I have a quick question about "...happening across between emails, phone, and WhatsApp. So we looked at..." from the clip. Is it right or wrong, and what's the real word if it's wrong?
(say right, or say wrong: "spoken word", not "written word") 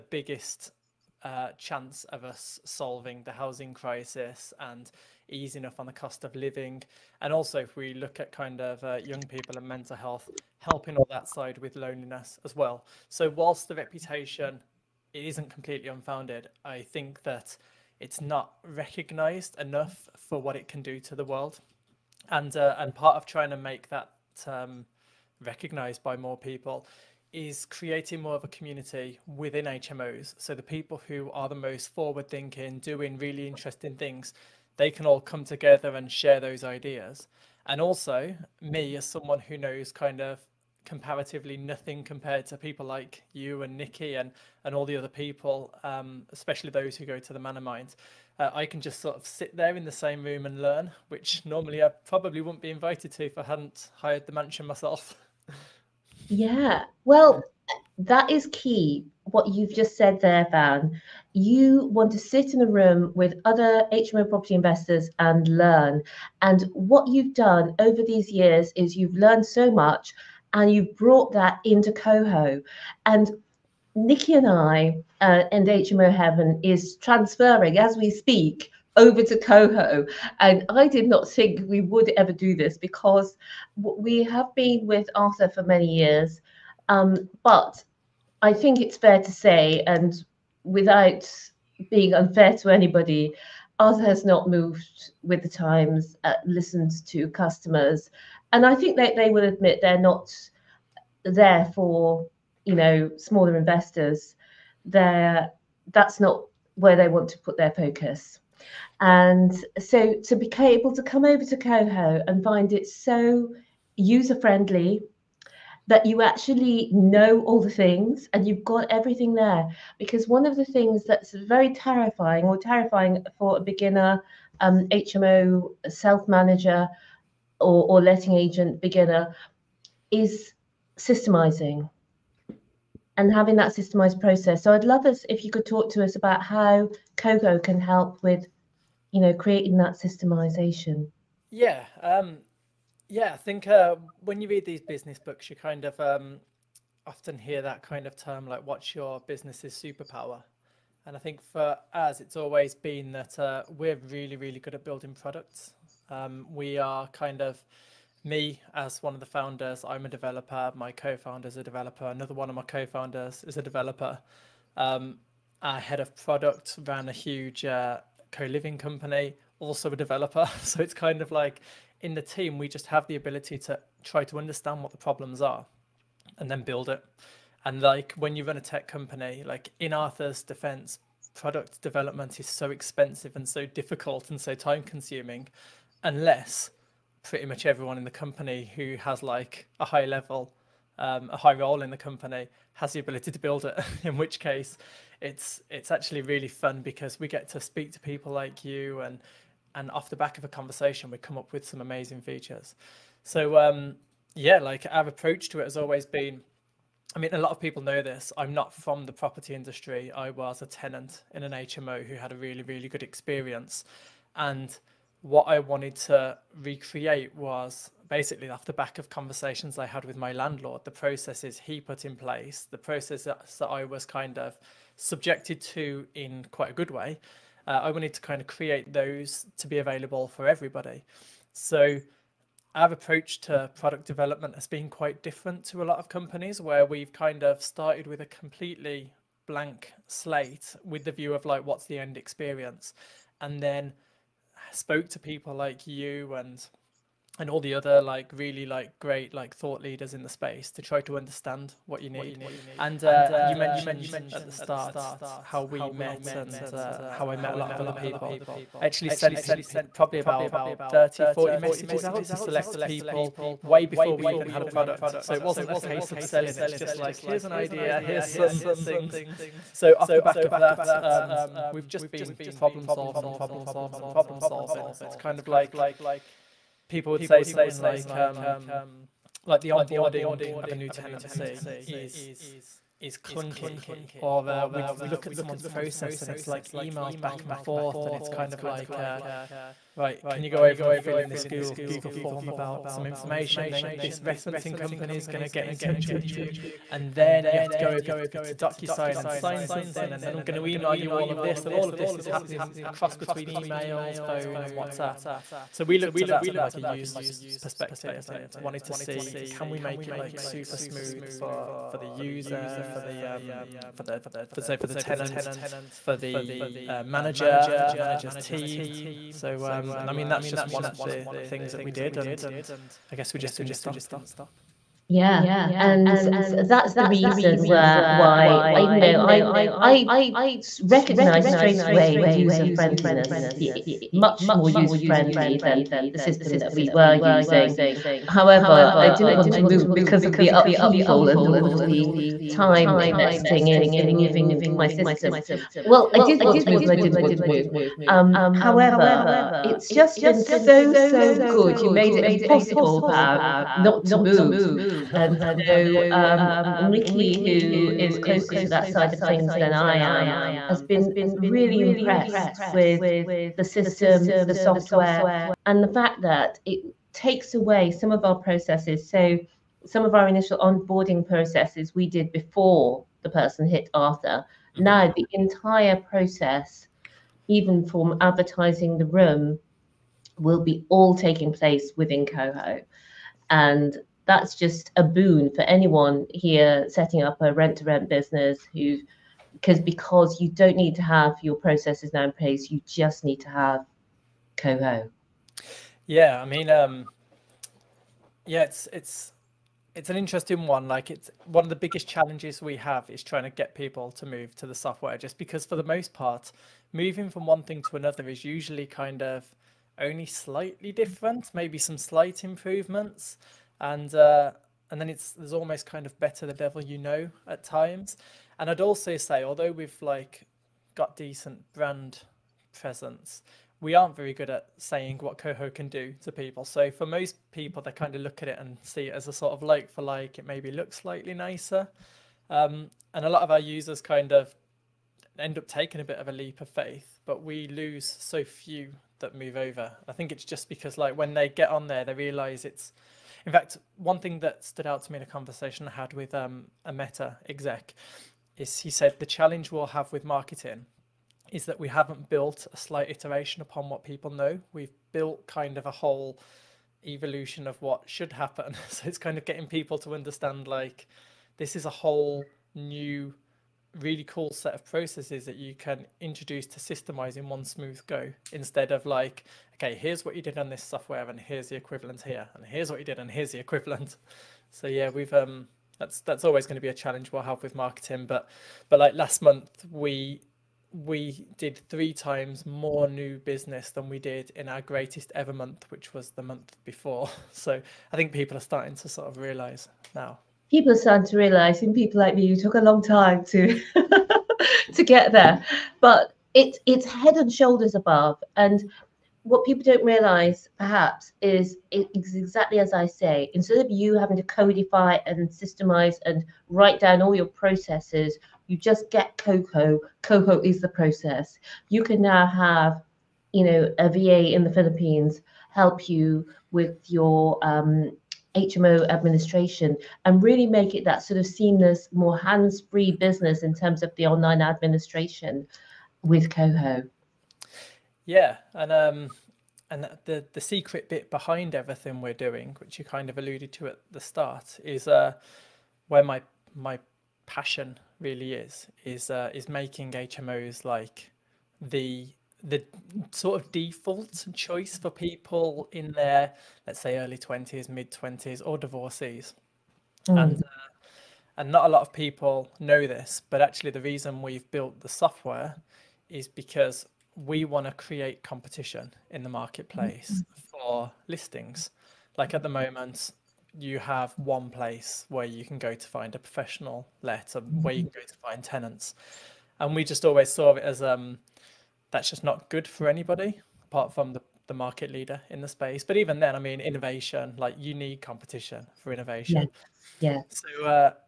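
right.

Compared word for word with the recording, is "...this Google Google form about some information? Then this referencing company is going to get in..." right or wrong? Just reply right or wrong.
right.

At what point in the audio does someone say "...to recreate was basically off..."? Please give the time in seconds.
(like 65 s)
215 s.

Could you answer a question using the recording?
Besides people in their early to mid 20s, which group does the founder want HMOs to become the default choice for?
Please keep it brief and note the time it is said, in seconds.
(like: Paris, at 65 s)
Divorcees, at 548 s.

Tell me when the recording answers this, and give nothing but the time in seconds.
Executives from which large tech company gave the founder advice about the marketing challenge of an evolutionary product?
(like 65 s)
446 s.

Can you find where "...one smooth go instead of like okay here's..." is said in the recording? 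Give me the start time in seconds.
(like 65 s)
467 s.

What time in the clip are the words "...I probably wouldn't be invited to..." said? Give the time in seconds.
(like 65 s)
51 s.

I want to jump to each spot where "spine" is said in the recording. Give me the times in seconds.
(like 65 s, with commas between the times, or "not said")
not said.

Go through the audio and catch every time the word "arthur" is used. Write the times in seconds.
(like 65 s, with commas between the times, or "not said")
85 s, 93 s, 179 s, 373 s.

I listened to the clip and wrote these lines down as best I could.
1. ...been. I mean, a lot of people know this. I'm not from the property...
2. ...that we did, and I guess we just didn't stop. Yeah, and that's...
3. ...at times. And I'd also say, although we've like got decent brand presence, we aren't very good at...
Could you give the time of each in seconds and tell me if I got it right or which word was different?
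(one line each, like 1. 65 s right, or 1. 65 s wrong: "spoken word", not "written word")
1. 206 s right
2. 321 s right
3. 417 s right.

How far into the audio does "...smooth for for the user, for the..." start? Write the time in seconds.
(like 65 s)
310 s.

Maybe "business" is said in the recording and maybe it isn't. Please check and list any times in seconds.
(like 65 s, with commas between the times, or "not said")
144 s, 149 s, 388 s, 483 s, 523 s.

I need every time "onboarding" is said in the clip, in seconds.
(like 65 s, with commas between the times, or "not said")
279 s, 370 s.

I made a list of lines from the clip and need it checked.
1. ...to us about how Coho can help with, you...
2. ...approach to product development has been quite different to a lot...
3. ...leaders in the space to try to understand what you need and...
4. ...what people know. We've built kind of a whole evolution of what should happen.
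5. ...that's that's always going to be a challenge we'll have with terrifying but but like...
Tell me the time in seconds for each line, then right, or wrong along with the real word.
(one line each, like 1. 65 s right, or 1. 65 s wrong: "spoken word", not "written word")
1. 135 s right
2. 232 s right
3. 249 s right
4. 453 s right
5. 475 s wrong: "marketing", not "terrifying".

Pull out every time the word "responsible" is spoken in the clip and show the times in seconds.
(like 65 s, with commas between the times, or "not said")
not said.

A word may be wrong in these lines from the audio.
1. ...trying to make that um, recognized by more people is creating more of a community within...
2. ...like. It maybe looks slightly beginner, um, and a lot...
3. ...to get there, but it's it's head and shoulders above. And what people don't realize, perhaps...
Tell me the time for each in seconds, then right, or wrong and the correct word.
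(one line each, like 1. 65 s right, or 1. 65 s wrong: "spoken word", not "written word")
1. 23 s right
2. 430 s wrong: "nicer", not "beginner"
3. 494 s right.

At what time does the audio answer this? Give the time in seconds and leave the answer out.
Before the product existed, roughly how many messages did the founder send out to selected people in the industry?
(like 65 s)
260 s.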